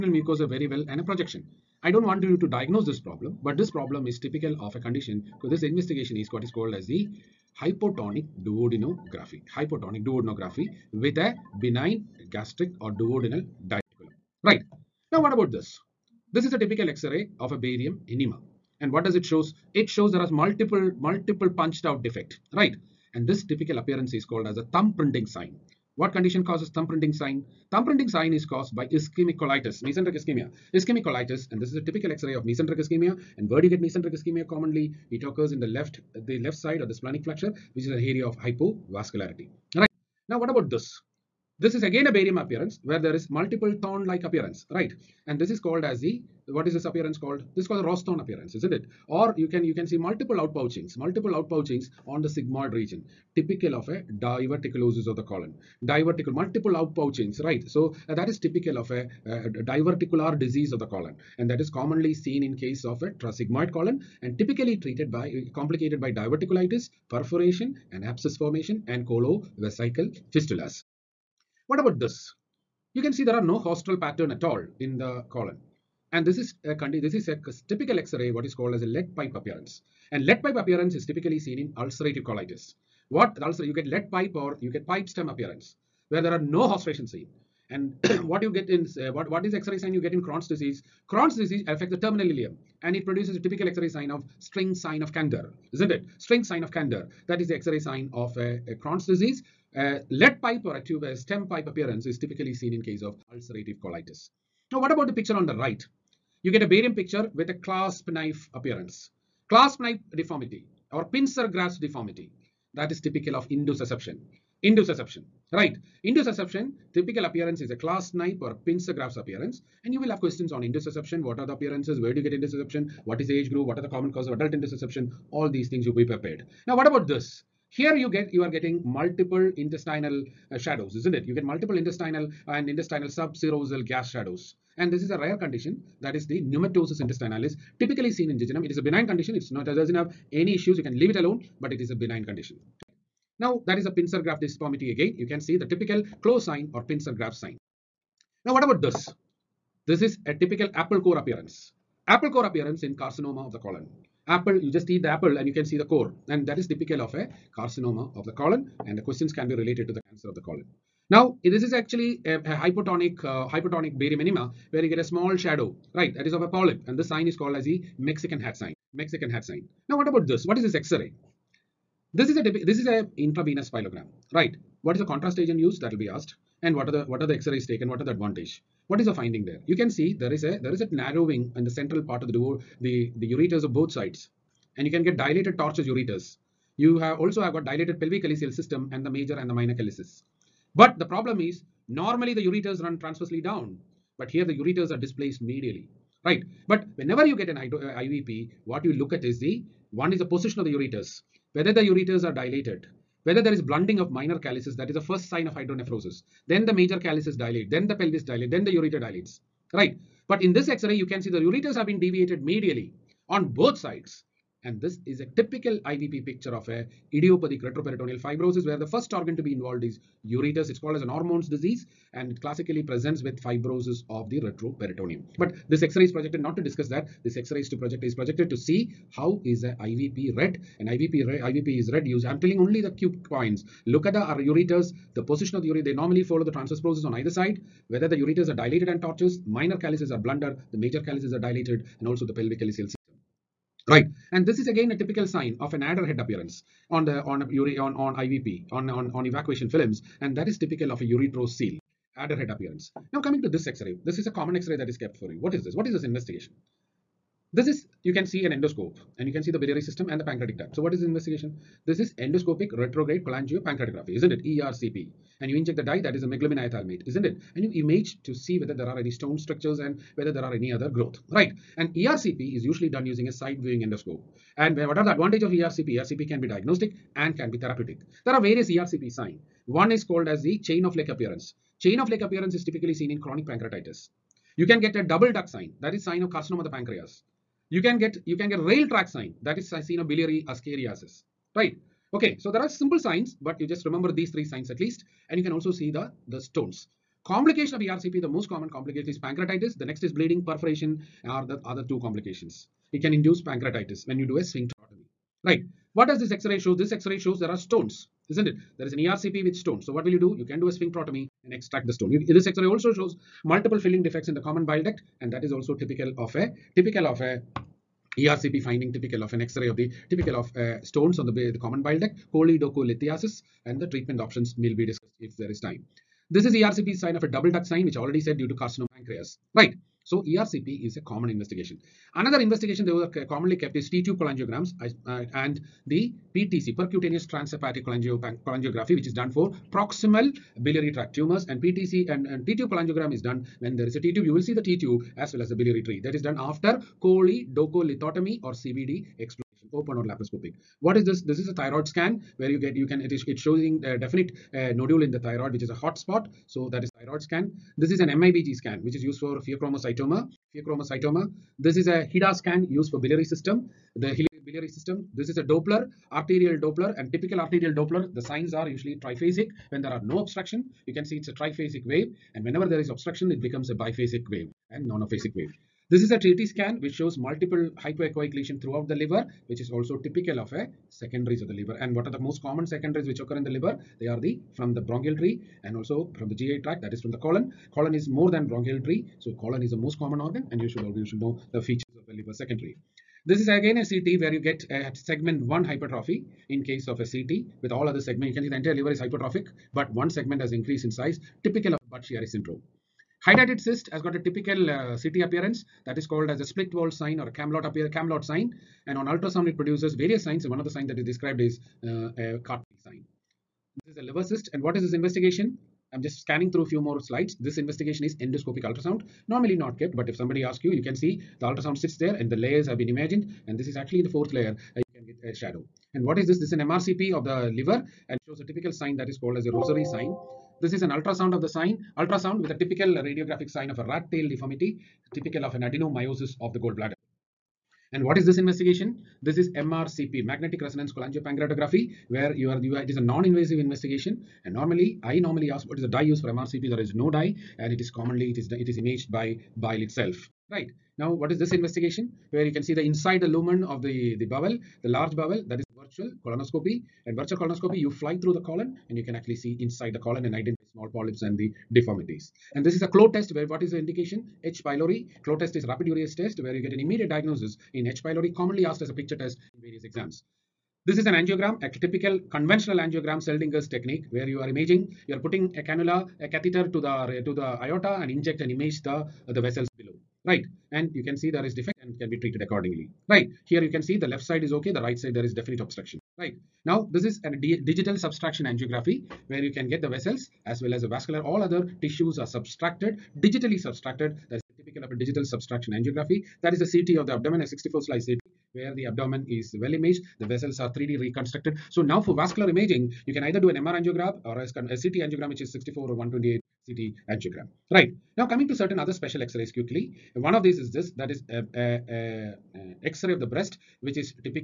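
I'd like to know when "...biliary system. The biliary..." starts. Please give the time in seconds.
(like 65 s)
362 s.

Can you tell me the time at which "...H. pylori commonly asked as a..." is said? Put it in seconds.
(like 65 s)
467 s.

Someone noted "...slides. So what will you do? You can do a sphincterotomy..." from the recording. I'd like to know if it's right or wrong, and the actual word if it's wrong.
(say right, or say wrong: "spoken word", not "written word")
wrong: "stones", not "slides".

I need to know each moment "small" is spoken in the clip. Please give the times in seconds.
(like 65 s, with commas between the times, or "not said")
165 s, 460 s.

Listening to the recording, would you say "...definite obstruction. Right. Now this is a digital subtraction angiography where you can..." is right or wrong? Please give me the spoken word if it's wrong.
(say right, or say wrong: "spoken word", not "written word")
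right.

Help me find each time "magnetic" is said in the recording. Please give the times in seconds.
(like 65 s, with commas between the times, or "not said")
440 s.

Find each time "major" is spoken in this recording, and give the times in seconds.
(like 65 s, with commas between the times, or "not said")
189 s, 206 s, 240 s.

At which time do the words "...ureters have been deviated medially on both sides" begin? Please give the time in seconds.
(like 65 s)
211 s.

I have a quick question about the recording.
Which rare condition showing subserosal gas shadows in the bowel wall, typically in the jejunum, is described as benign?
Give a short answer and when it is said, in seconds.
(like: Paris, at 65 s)
Pneumatosis intestinalis, at 136 s.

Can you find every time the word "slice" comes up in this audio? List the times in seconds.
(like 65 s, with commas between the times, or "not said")
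497 s.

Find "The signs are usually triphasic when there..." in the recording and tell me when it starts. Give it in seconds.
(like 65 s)
368 s.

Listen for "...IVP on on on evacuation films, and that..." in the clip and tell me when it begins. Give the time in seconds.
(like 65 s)
248 s.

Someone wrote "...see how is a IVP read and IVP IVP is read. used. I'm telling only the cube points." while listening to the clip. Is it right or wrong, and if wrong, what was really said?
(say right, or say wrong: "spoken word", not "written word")
right.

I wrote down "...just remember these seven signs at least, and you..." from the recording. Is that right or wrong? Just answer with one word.
wrong.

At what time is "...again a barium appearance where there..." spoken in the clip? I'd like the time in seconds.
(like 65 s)
41 s.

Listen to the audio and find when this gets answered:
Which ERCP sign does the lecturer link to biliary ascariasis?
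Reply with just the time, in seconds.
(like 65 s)
288 s.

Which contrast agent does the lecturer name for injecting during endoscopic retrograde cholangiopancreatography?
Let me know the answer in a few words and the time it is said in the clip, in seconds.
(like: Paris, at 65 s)
Meglumine iothalamate, at 266 s.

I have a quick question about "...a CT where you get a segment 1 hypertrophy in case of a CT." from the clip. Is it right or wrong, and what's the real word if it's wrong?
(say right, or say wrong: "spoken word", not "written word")
right.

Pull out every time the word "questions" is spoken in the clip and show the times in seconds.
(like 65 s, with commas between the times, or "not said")
120 s, 159 s.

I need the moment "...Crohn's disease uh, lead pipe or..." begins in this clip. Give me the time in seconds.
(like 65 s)
98 s.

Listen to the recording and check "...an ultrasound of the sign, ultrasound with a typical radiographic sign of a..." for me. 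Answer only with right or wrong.
right.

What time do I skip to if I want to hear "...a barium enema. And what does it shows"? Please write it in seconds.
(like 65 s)
17 s.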